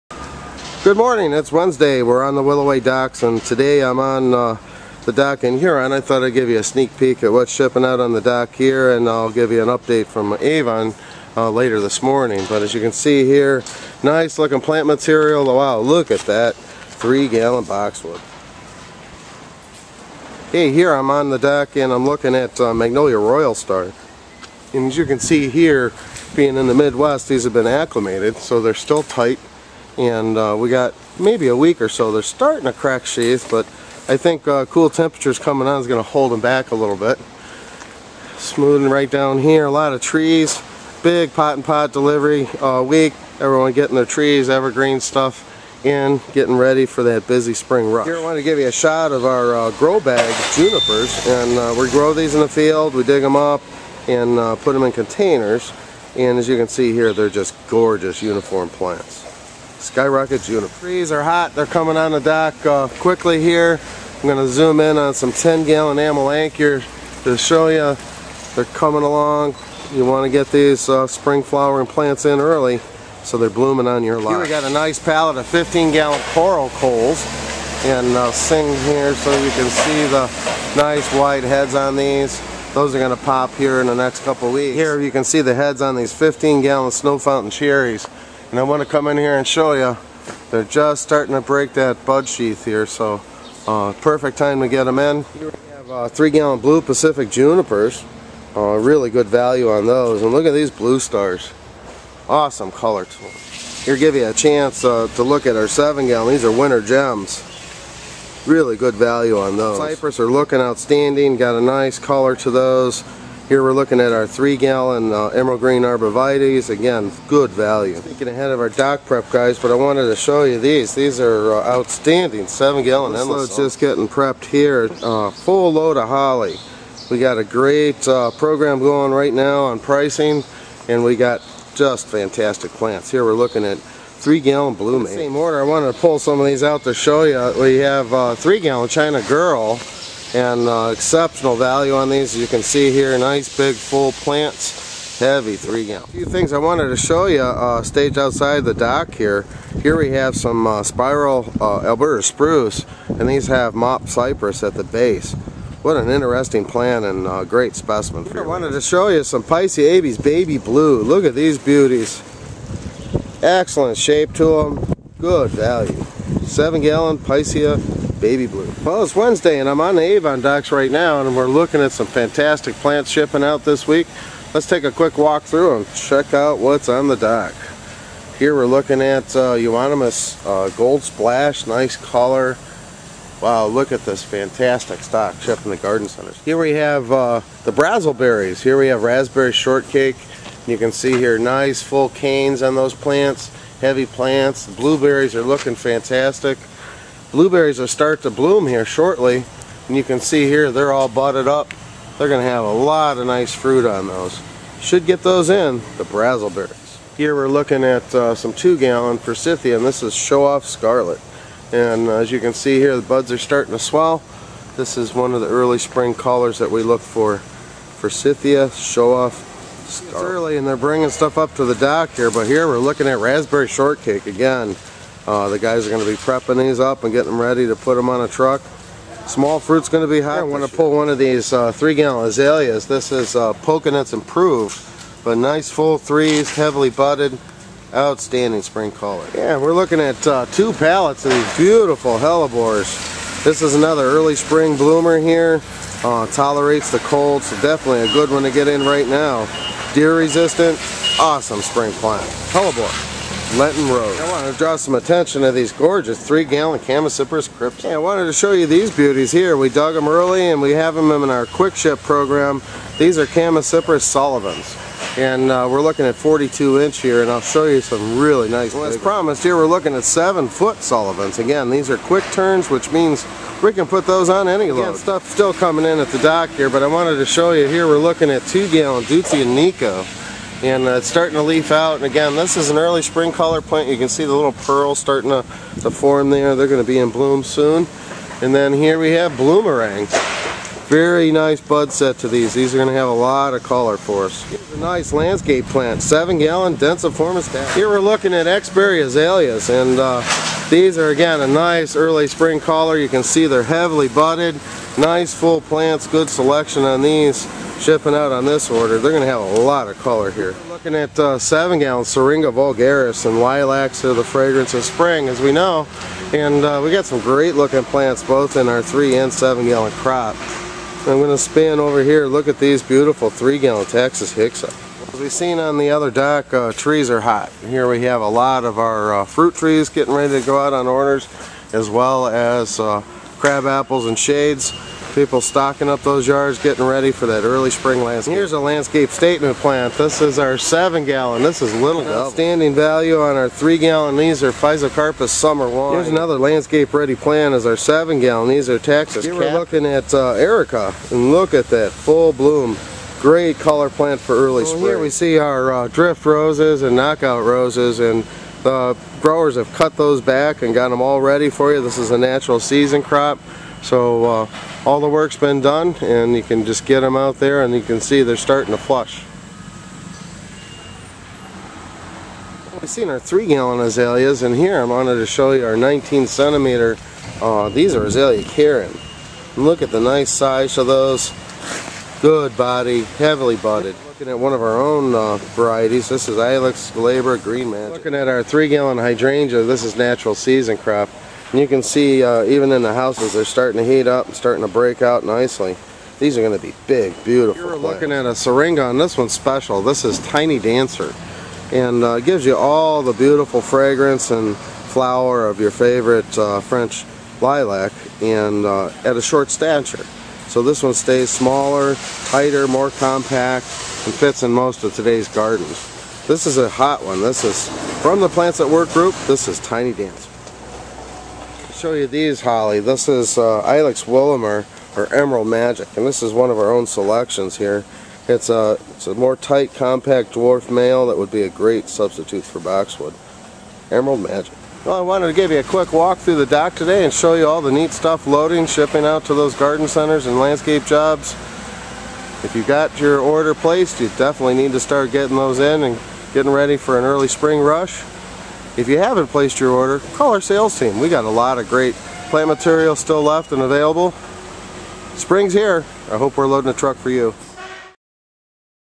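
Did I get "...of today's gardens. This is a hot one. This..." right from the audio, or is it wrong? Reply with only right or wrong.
right.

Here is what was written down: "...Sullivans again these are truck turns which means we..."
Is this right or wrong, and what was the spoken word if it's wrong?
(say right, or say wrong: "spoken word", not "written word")
wrong: "quick", not "truck".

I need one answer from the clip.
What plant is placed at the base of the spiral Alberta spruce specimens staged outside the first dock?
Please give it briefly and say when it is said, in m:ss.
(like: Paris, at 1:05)
Mop cypress, at 2:33.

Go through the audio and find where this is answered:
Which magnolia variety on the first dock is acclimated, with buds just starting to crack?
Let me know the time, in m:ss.
0:22.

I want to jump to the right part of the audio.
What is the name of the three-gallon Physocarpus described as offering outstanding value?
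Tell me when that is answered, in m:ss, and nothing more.
5:44.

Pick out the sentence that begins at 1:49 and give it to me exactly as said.
Cypress are looking outstanding got a nice color to those here we're looking at our three gallon uh, emerald green arborvitaes.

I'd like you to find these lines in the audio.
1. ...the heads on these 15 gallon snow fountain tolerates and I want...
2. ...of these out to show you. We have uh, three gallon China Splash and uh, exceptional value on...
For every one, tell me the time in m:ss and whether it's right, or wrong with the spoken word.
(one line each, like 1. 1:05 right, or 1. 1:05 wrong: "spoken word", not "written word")
1. 1:25 wrong: "cherries", not "tolerates"
2. 2:16 wrong: "Girl", not "Splash".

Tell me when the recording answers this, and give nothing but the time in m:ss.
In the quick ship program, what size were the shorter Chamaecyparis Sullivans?
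4:26.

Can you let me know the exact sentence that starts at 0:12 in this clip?
But as you can see here, nice looking plant material.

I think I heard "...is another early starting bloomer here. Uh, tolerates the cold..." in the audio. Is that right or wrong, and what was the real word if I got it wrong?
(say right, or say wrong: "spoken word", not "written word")
wrong: "spring", not "starting".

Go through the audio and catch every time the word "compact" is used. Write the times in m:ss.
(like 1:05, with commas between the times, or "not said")
6:52, 7:09.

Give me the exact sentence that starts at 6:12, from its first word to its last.
We've seen our three gallon azaleas and here I wanted to show you our 19 centimeter, uh, these are azalea Karen.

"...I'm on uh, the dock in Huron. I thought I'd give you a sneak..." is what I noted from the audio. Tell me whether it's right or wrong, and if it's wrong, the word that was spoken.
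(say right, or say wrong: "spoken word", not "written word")
right.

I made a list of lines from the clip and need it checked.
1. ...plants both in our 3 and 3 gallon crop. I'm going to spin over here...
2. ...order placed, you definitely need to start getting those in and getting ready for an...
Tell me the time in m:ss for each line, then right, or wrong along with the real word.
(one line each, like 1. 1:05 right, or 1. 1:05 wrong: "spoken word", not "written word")
1. 5:17 wrong: "7", not "3"
2. 7:23 right.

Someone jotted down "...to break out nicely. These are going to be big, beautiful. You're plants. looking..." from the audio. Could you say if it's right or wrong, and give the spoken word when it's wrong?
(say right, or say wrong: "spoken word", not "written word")
right.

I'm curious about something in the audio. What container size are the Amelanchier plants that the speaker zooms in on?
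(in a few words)
10 gallon.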